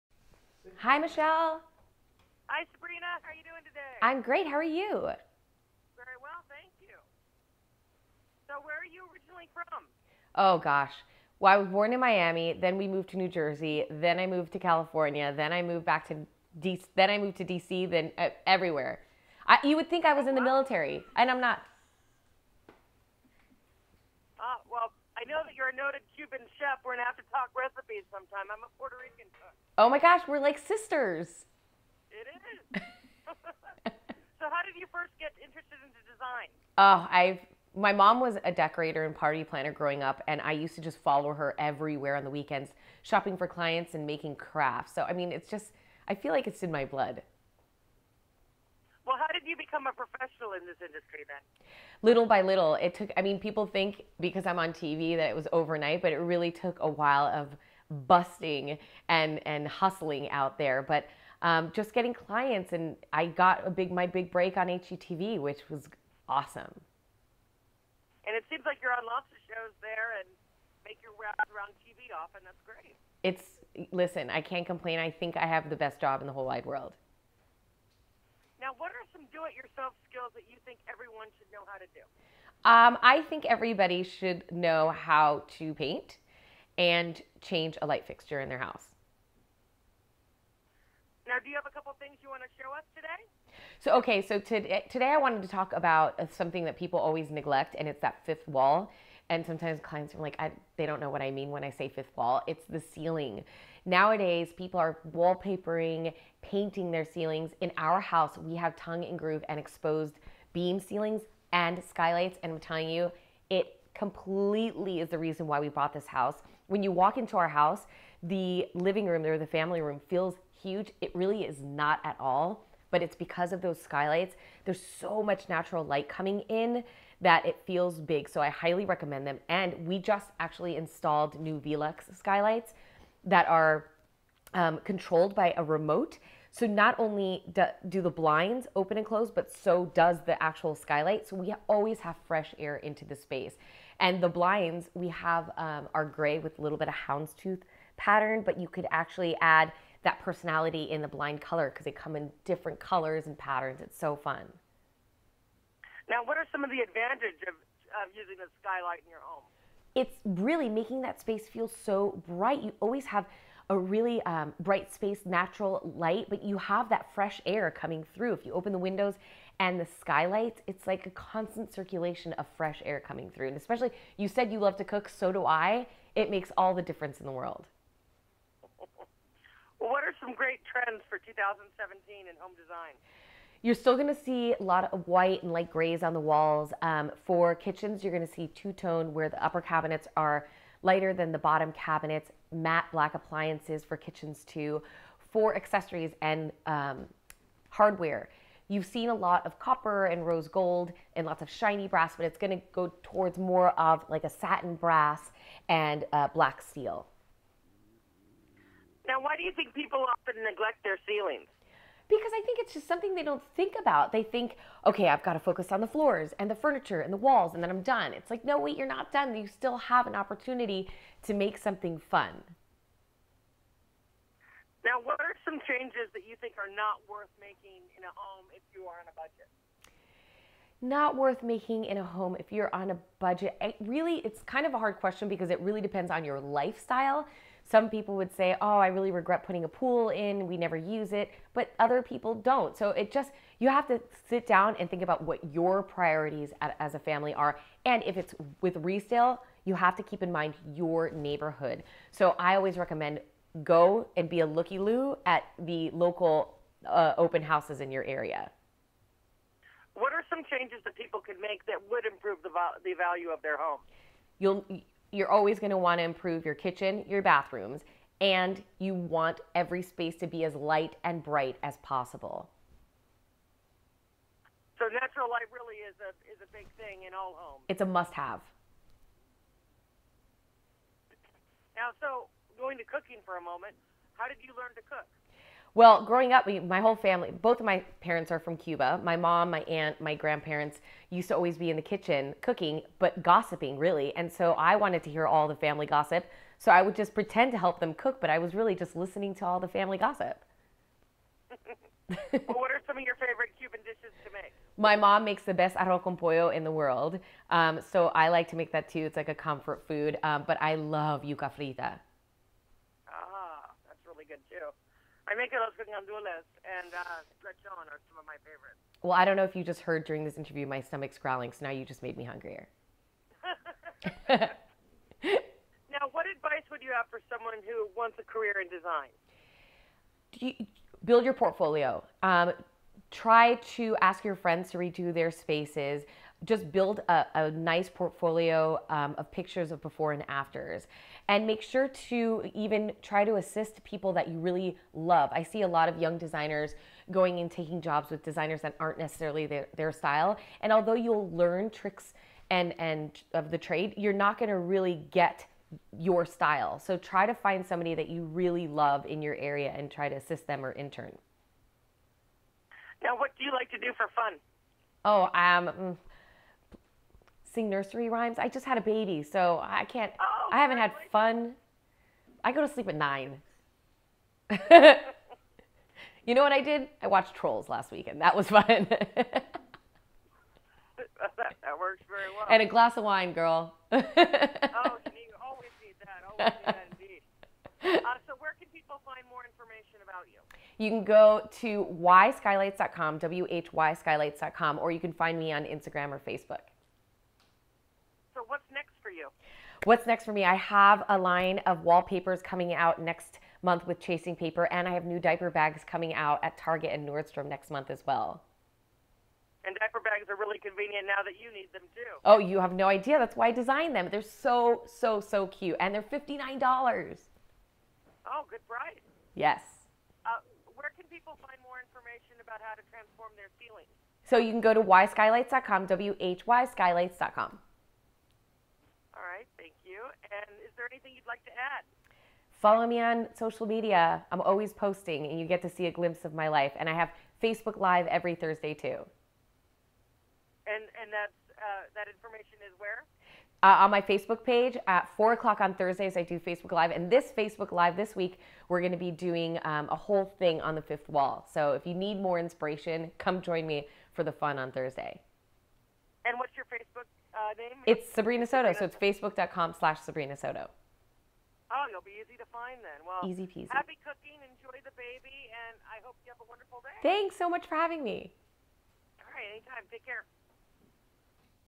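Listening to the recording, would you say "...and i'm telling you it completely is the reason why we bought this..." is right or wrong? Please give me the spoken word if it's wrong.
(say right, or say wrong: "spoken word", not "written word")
right.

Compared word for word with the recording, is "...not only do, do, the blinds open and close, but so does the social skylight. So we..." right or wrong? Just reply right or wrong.
wrong.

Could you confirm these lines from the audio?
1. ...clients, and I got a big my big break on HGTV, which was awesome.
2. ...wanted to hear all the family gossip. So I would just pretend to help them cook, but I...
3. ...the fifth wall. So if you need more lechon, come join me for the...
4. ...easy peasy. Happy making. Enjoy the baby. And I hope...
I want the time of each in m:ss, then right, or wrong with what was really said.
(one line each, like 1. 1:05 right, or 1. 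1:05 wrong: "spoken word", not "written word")
1. 1:02 right
2. 4:54 right
3. 7:30 wrong: "inspiration", not "lechon"
4. 7:43 wrong: "cooking", not "making".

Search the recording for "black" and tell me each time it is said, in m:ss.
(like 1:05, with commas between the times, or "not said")
3:12, 3:26.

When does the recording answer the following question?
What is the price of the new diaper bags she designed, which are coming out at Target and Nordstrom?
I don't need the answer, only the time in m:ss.
6:56.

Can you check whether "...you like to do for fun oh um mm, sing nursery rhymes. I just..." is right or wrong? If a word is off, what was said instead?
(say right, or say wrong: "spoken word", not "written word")
right.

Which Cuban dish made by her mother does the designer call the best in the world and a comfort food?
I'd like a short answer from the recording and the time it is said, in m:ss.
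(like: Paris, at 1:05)
Arroz con pollo, at 5:05.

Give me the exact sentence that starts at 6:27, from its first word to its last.
Uh, so, where can people find more information about you?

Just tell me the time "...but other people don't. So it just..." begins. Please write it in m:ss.
4:01.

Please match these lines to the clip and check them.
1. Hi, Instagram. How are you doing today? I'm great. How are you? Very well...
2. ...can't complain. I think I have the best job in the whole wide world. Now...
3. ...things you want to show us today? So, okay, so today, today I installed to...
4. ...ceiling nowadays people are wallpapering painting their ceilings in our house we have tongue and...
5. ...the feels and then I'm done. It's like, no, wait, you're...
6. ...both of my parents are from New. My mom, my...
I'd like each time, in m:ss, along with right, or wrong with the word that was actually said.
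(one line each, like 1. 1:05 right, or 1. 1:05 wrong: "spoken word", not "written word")
1. 0:02 wrong: "Sabrina", not "Instagram"
2. 1:14 right
3. 1:31 wrong: "wanted", not "installed"
4. 1:42 right
5. 3:37 wrong: "walls", not "feels"
6. 4:47 wrong: "Cuba", not "New".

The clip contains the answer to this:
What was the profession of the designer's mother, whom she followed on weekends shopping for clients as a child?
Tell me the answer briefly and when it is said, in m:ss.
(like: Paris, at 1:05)
Decorator and party planner, at 0:38.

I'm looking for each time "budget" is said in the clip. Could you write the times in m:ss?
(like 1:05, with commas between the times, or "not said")
3:49, 3:53.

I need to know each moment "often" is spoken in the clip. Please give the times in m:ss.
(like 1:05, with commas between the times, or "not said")
1:12, 3:30.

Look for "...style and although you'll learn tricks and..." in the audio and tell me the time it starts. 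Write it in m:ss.
5:49.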